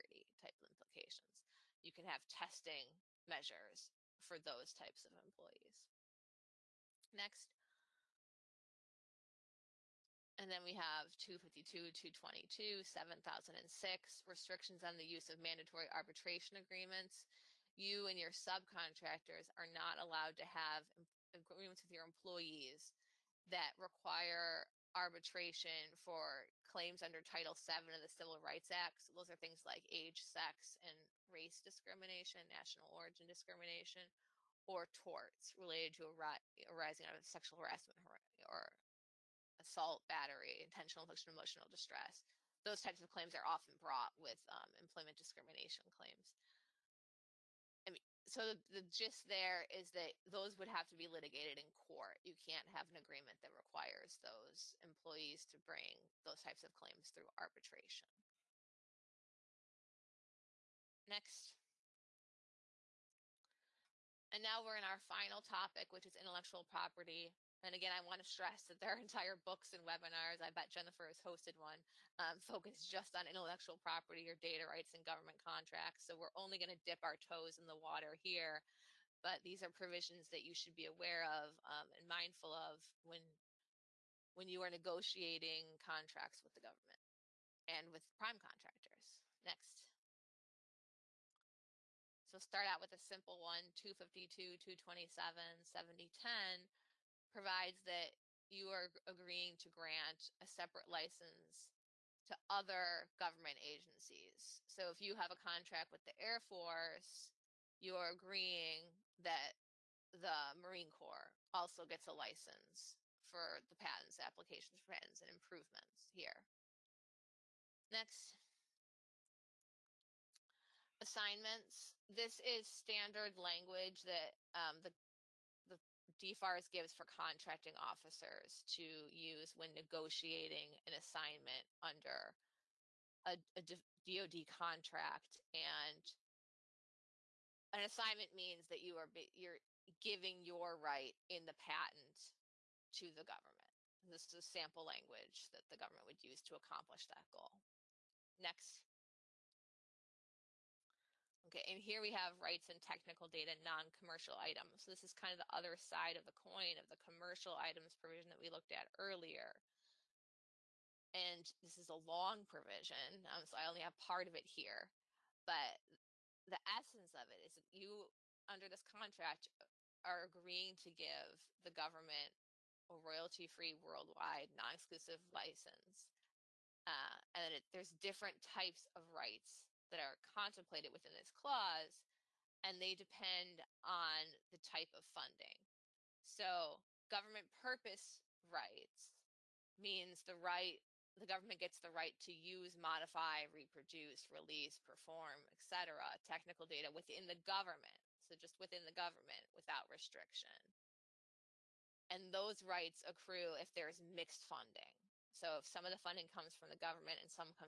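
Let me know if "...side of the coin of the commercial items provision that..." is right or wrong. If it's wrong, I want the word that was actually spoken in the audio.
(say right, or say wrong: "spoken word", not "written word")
right.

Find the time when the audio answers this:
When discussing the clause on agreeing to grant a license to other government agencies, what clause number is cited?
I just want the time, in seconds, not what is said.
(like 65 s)
93 s.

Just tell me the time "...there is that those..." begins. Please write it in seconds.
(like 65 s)
49 s.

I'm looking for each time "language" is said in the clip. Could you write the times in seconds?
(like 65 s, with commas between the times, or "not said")
123 s, 144 s.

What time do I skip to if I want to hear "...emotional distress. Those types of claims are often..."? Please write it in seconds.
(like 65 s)
41 s.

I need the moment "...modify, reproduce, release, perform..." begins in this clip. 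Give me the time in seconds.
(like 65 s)
192 s.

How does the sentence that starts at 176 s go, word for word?
Uh, and it, there's different types of rights that are contemplated within this clause, and they depend on the type of funding.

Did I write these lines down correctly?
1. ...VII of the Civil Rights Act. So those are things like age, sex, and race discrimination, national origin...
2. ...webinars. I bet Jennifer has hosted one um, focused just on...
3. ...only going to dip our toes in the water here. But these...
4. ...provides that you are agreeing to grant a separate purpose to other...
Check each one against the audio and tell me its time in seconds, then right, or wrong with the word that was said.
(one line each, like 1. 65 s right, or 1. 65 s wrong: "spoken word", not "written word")
1. 27 s right
2. 69 s right
3. 76 s right
4. 97 s wrong: "license", not "purpose".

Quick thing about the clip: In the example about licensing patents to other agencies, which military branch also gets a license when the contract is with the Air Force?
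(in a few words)
Marine Corps.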